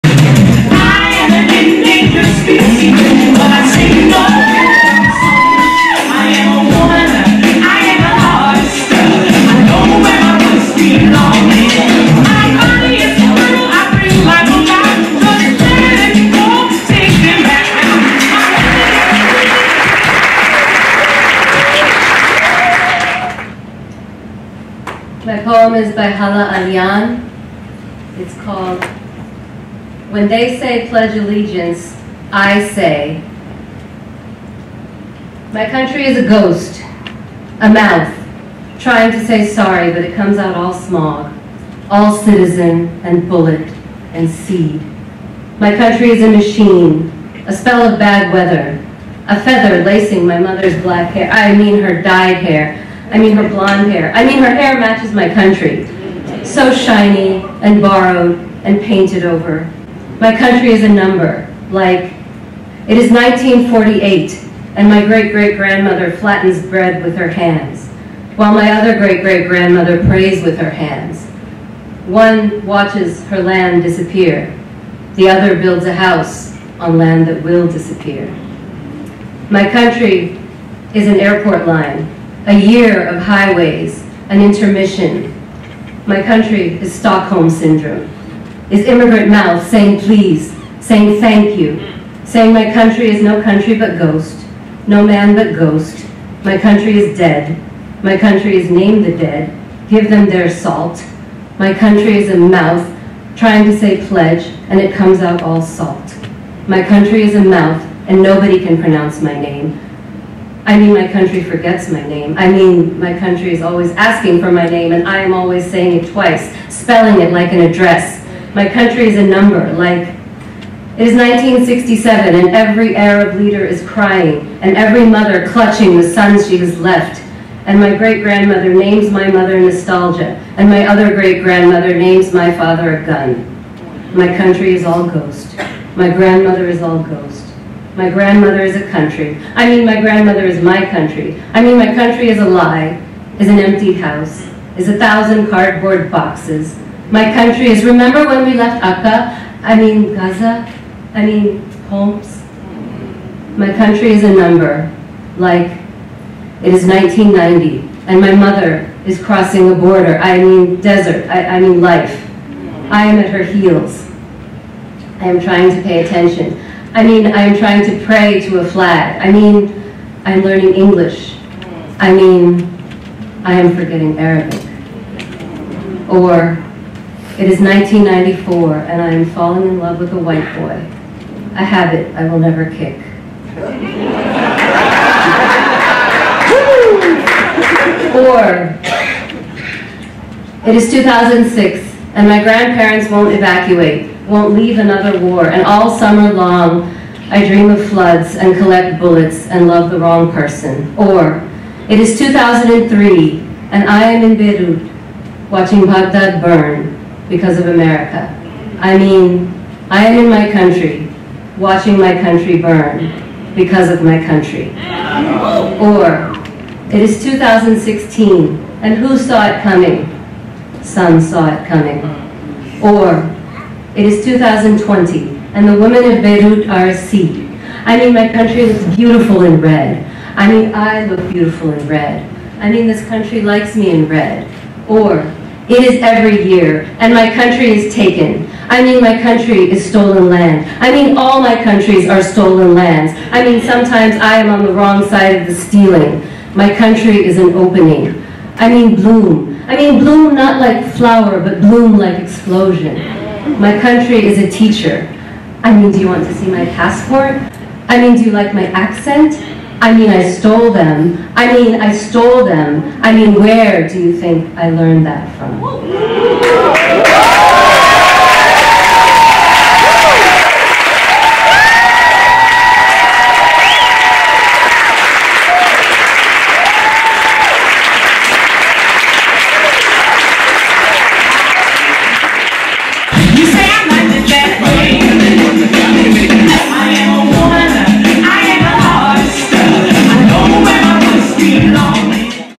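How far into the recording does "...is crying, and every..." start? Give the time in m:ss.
2:03.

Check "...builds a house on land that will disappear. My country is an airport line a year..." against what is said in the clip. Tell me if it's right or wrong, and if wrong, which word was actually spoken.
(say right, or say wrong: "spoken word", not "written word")
right.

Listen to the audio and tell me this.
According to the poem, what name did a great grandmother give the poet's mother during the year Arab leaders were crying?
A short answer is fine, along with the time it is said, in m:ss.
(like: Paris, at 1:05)
Nostalgia, at 2:09.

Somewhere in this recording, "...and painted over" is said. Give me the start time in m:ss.
0:58.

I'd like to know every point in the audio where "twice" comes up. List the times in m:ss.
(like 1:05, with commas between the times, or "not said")
1:56.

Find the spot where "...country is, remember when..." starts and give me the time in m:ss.
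2:27.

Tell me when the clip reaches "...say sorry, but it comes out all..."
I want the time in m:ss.
0:39.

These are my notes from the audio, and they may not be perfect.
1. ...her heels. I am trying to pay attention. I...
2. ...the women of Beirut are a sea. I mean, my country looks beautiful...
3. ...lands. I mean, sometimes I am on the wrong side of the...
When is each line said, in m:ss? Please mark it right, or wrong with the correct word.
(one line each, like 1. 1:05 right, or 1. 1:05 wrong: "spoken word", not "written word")
1. 2:43 right
2. 3:45 right
3. 4:02 right.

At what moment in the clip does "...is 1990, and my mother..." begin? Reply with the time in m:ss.
2:36.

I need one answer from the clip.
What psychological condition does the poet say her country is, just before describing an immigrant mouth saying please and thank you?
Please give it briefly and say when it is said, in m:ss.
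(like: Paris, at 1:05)
Stockholm Syndrome, at 1:26.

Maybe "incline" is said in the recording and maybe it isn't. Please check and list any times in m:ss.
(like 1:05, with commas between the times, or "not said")
not said.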